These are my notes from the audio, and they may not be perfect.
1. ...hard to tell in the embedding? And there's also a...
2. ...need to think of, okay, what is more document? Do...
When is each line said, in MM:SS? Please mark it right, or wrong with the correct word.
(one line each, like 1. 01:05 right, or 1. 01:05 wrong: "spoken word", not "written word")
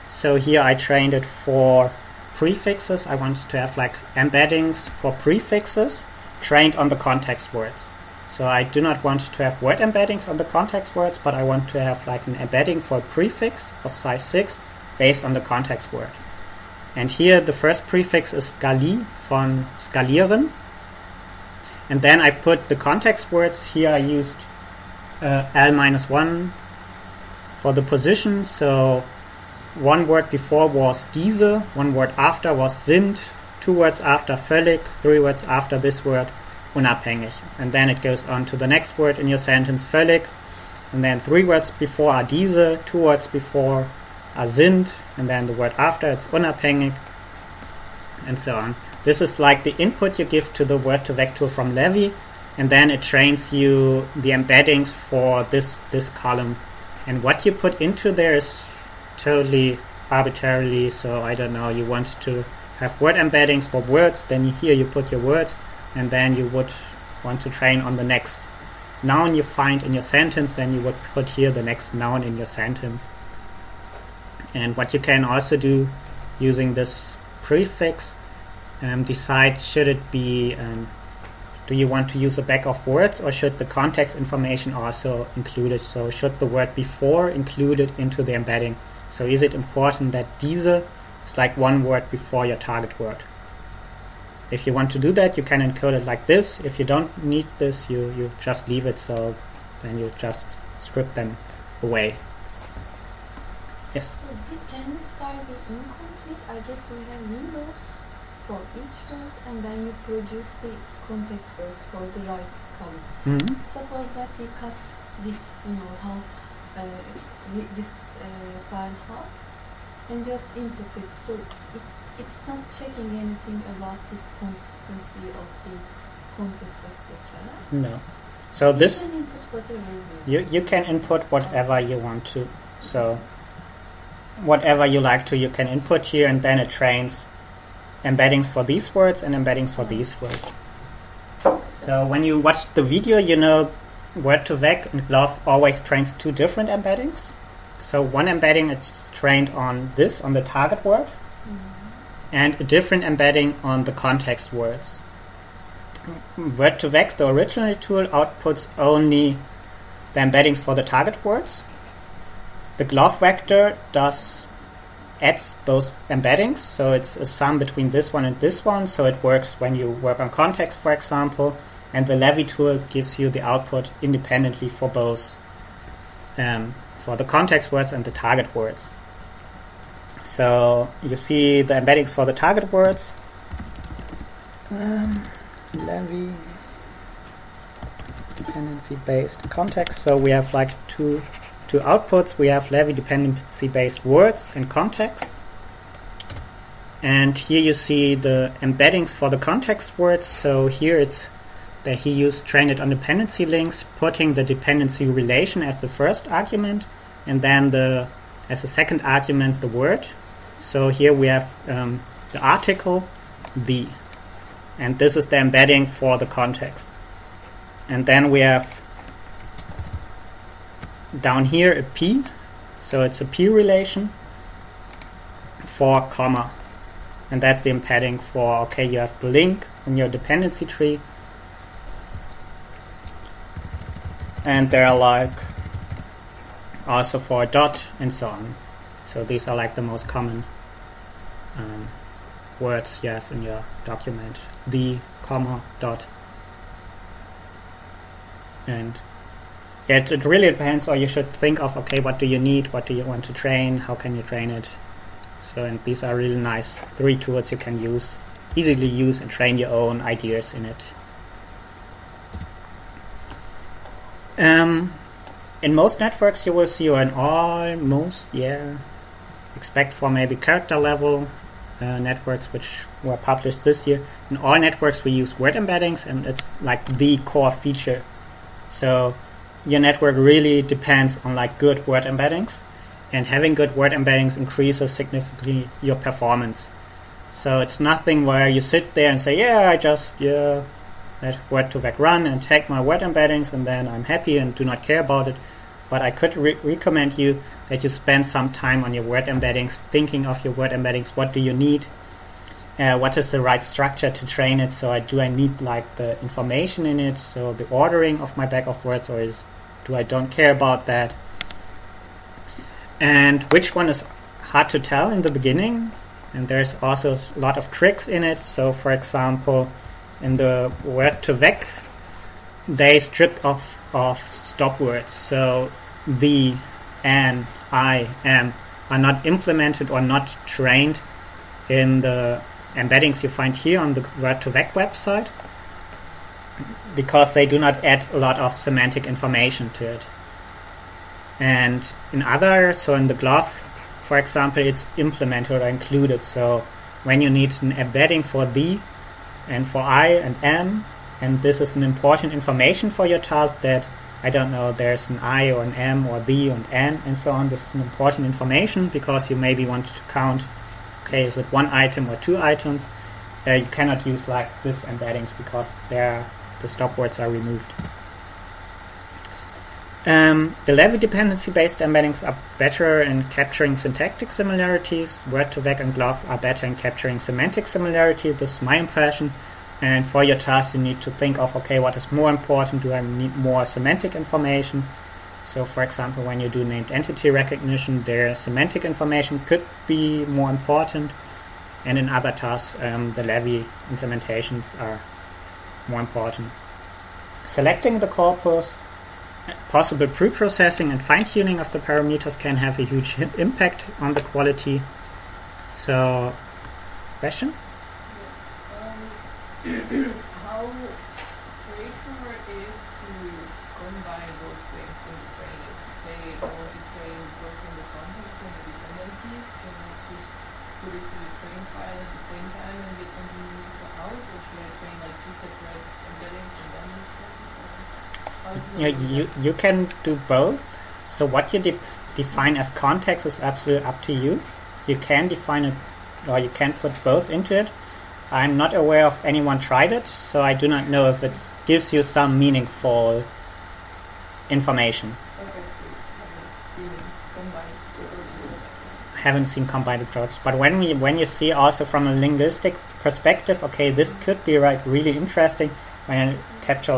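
1. 05:14 wrong: "beginning", not "embedding"
2. 06:20 wrong: "important", not "document".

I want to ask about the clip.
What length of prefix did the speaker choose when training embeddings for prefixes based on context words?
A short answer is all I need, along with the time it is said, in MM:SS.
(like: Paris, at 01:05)
6, at 00:13.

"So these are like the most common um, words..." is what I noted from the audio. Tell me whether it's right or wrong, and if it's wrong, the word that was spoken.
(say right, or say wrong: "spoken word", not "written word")
right.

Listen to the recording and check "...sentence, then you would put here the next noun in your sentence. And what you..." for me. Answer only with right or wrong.
right.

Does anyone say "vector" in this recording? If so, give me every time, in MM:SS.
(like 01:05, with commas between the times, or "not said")
00:51, 02:43.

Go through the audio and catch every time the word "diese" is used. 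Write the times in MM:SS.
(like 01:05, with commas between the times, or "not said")
00:31, 00:42, 01:30.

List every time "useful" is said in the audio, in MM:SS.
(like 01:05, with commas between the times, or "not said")
07:03.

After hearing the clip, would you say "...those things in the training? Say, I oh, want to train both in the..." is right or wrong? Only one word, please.
right.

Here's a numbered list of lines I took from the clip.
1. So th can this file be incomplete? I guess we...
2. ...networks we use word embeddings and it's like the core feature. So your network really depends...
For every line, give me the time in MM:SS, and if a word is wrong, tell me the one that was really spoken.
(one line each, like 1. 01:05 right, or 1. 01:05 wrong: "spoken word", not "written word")
1. 01:44 right
2. 04:34 right.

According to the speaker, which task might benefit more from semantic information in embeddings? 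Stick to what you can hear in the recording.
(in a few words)
named entity recognition.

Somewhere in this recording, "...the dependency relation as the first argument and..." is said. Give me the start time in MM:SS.
03:24.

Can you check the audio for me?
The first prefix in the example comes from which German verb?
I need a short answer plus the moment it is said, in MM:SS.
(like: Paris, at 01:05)
skalieren, at 00:19.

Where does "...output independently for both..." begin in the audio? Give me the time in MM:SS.
02:53.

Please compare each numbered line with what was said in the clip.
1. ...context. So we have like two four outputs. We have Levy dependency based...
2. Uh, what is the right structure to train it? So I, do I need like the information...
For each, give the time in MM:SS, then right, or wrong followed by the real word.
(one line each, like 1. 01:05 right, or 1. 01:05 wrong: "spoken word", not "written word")
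1. 03:09 wrong: "two", not "four"
2. 05:02 right.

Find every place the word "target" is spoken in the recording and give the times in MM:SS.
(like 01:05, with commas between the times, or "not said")
01:32, 02:30, 02:40, 02:58, 03:02.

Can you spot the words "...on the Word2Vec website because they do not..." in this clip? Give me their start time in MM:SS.
05:33.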